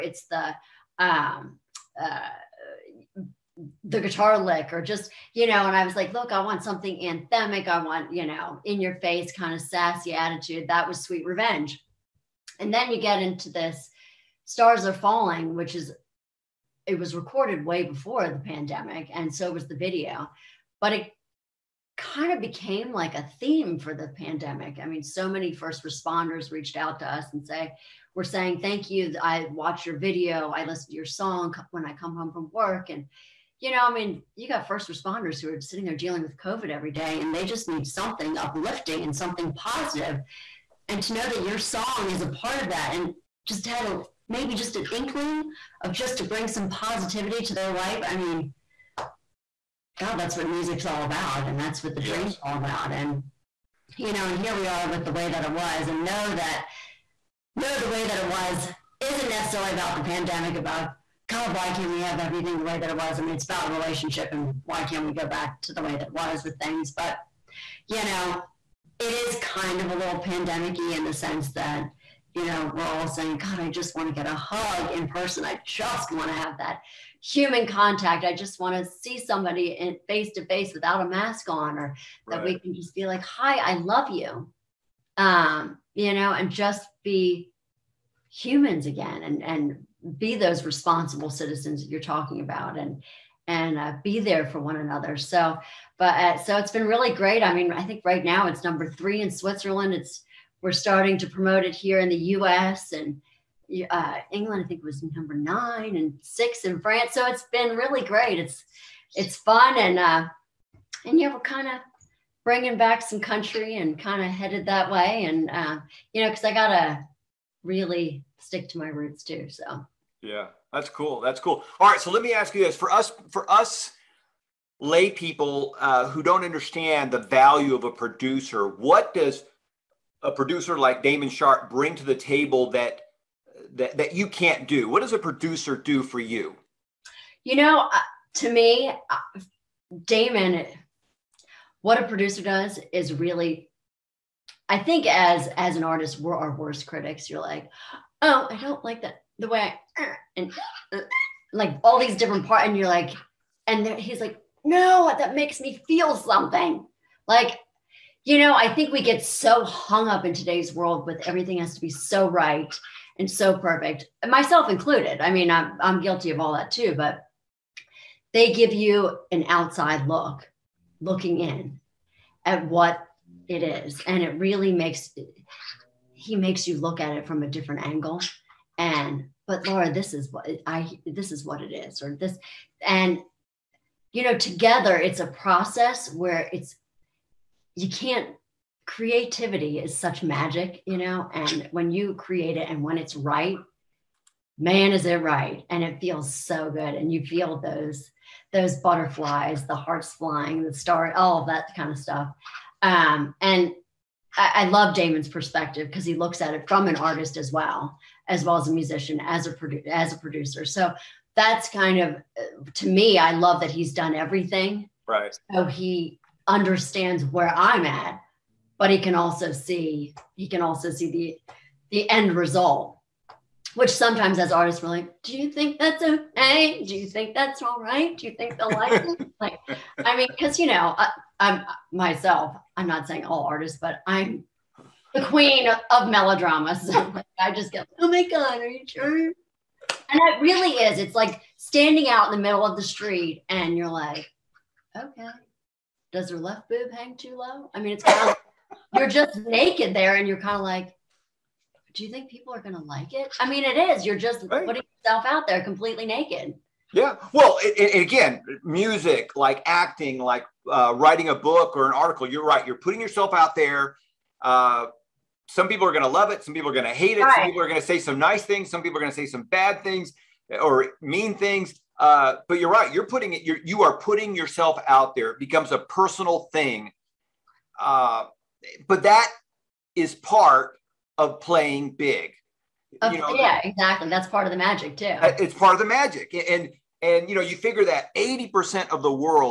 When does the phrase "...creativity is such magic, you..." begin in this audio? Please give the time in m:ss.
3:08.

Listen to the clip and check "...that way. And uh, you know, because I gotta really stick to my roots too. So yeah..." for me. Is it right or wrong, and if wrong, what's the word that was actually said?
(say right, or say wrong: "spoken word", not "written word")
right.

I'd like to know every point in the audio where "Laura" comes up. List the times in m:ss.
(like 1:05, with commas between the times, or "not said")
2:59.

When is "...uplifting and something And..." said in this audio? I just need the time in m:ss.
0:38.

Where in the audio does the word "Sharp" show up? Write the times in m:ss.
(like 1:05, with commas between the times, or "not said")
2:11.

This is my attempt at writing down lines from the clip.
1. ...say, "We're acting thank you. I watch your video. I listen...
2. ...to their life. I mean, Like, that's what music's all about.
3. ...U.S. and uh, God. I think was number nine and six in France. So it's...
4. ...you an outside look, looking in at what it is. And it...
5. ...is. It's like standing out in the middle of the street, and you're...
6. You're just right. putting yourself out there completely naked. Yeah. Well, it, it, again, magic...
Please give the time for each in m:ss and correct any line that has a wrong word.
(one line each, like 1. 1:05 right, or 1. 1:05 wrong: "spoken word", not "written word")
1. 0:27 wrong: "saying", not "acting"
2. 0:47 wrong: "God", not "Like"
3. 1:42 wrong: "England", not "God"
4. 2:48 right
5. 4:00 right
6. 4:14 wrong: "music", not "magic".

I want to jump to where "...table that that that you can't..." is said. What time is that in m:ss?
2:12.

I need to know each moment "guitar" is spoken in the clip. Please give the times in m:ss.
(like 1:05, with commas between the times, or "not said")
0:03.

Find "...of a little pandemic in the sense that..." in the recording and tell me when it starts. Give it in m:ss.
1:09.